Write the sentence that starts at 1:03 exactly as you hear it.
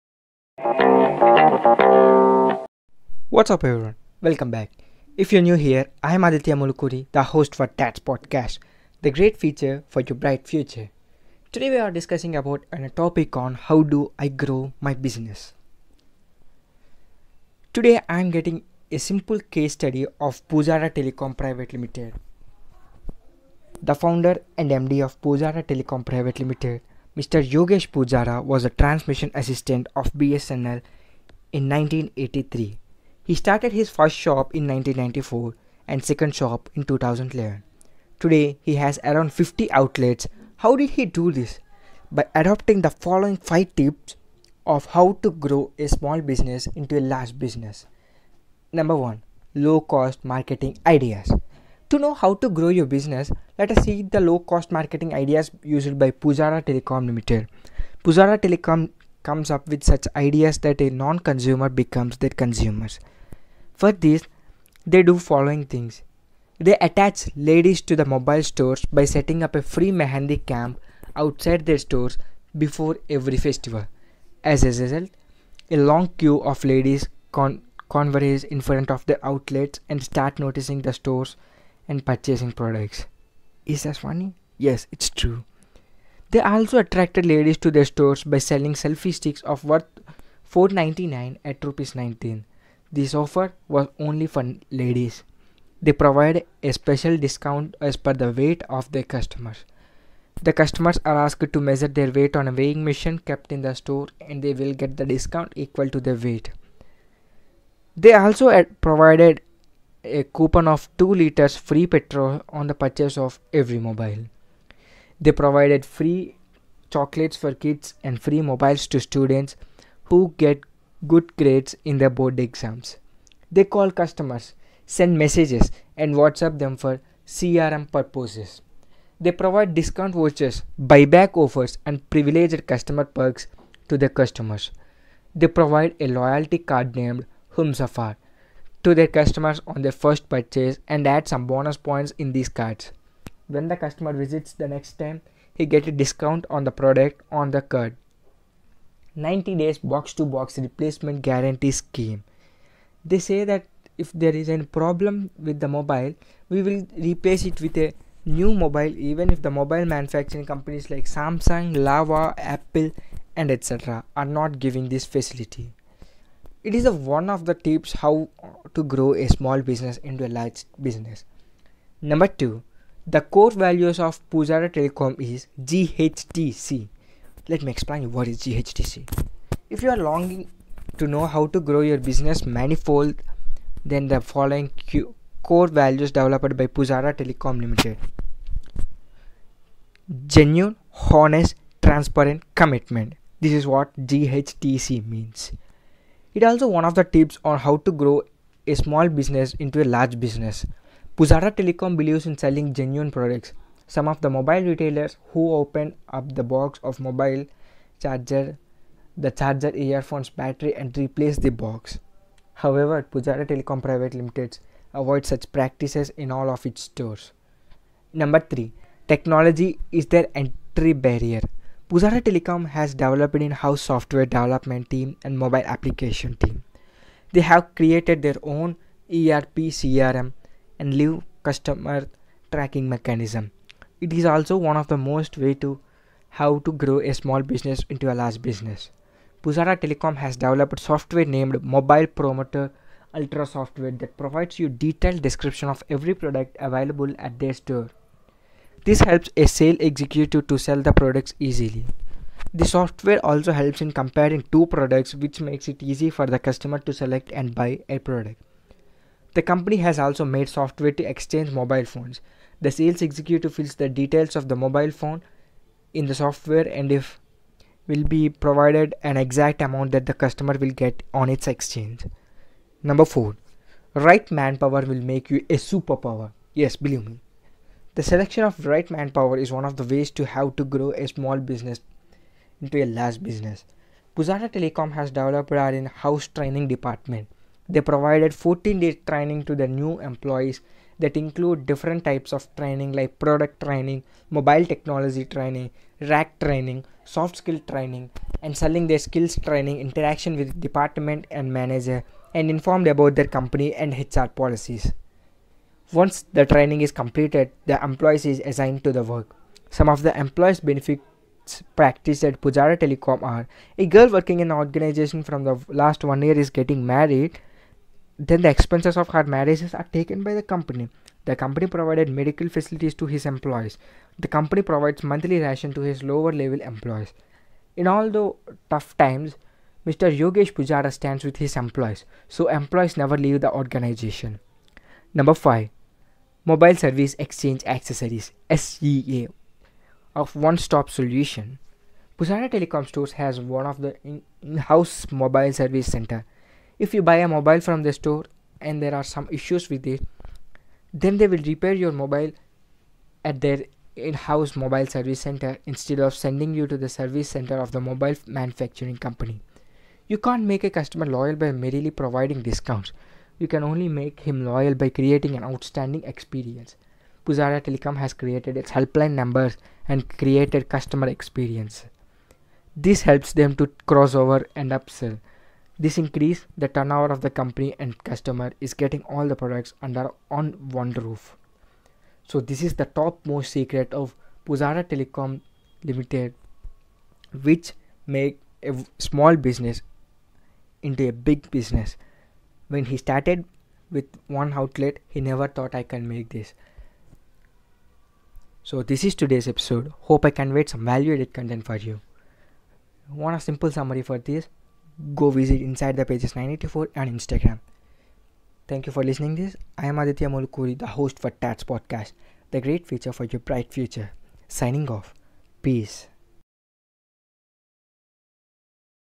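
For this, they do following things.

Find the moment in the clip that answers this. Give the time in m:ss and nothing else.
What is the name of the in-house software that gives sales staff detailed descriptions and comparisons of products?
4:01.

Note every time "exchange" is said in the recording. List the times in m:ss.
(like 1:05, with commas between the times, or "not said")
4:21, 4:31, 5:37.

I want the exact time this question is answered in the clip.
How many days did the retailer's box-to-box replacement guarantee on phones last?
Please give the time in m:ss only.
2:29.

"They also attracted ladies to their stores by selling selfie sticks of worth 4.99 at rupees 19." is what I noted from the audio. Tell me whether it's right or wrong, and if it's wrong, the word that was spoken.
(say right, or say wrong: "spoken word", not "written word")
right.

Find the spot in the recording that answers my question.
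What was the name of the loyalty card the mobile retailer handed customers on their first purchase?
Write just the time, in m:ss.
2:17.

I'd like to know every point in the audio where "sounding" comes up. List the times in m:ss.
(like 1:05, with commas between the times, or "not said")
not said.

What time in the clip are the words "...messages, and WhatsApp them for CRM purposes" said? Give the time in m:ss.
2:05.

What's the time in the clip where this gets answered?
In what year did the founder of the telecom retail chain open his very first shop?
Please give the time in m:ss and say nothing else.
0:34.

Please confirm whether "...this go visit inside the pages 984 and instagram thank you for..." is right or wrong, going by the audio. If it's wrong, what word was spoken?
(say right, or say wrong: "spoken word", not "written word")
right.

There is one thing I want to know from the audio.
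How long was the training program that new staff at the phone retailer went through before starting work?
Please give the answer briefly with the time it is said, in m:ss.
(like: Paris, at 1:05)
14 days, at 4:48.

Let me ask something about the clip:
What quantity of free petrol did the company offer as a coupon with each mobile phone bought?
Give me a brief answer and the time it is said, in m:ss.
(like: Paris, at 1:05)
2 liters, at 1:50.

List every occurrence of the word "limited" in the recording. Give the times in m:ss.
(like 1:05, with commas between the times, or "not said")
0:21, 0:26, 0:57, 3:07, 3:34, 6:25.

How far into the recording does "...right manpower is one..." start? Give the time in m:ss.
4:38.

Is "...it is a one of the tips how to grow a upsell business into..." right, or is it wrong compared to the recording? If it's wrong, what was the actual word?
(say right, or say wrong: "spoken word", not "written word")
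wrong: "small", not "upsell".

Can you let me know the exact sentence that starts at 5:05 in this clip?
Once the training is completed, the employees is assigned to the work.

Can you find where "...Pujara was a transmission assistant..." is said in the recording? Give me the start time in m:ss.
0:27.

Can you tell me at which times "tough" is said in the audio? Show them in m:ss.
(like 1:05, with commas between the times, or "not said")
5:28.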